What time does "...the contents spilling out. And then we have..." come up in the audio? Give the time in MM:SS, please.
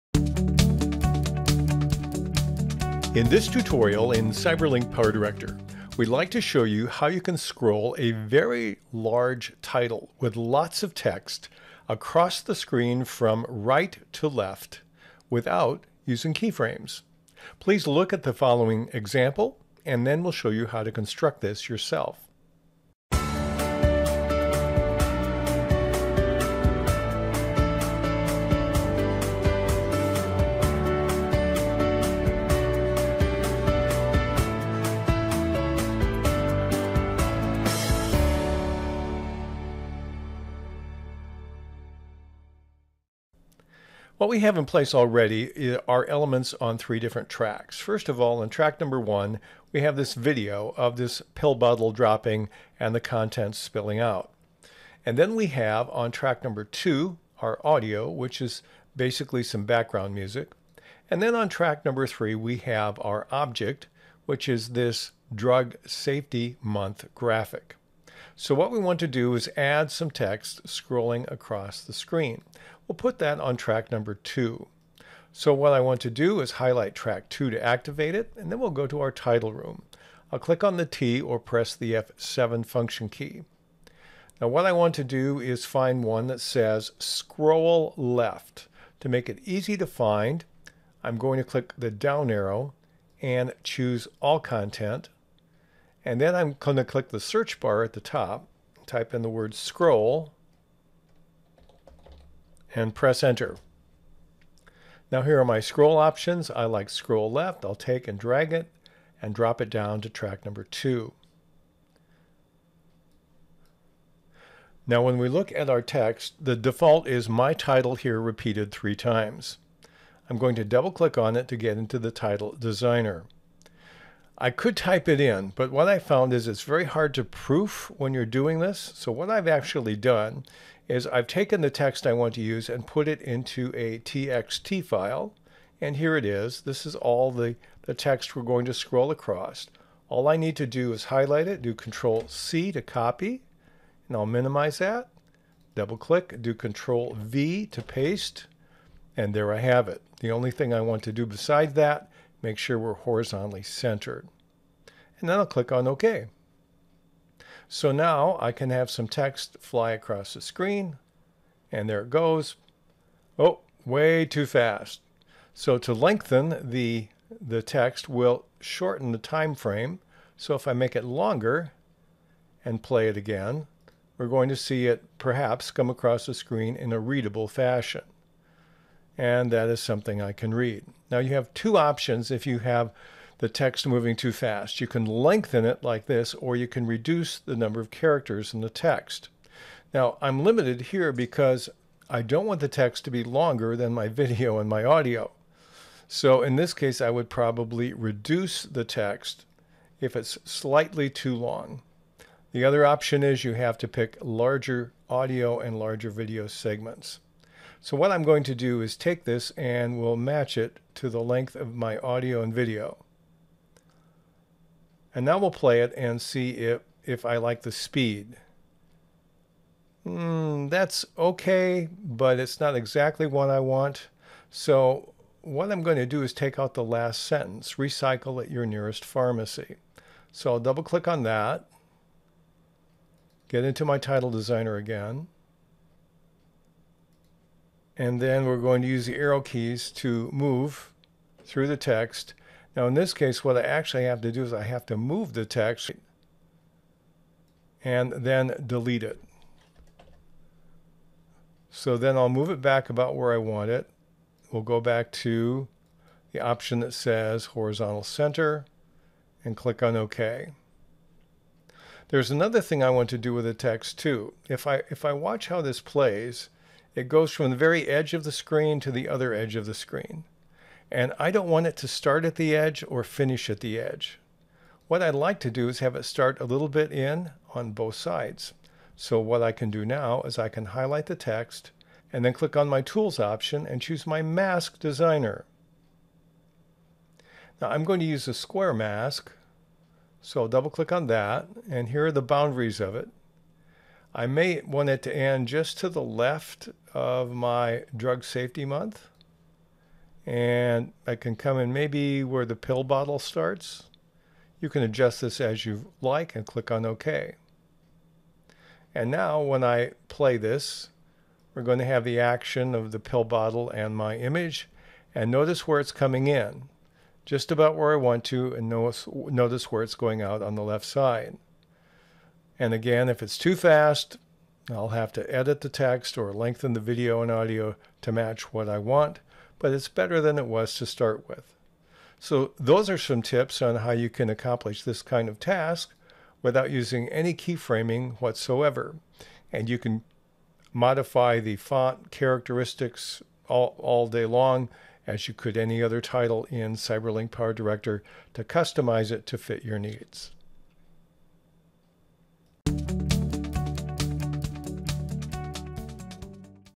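00:52.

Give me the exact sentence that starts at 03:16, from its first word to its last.
So in this case, I would probably reduce the text if it's slightly too long.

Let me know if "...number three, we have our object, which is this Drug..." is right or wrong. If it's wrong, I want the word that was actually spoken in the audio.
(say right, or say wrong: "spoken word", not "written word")
right.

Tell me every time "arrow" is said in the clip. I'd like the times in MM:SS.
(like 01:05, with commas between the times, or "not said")
01:32, 03:59.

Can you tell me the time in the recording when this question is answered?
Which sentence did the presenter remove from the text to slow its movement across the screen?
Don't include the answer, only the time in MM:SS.
03:47.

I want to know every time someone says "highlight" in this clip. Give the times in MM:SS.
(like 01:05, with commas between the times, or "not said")
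01:16, 02:21, 04:40.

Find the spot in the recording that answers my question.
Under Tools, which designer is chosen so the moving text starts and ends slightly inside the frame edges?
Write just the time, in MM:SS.
04:44.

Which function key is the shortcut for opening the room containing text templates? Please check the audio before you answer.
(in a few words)
F7.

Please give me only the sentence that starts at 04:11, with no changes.
So then I'll move it back about where I want it.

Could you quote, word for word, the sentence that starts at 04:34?
What I'd like to do is have it start a little bit in on both sides.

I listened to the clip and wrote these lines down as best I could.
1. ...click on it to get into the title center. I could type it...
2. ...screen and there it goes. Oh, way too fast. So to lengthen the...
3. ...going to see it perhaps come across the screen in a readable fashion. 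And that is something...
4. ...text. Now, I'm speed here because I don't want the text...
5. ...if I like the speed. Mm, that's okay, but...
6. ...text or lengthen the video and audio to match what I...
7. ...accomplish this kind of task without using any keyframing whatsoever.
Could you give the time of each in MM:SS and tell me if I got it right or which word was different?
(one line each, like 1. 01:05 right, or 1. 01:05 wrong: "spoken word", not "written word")
1. 02:00 wrong: "designer", not "center"
2. 02:40 right
3. 02:54 right
4. 03:08 wrong: "limited", not "speed"
5. 03:37 right
6. 05:25 right
7. 05:34 right.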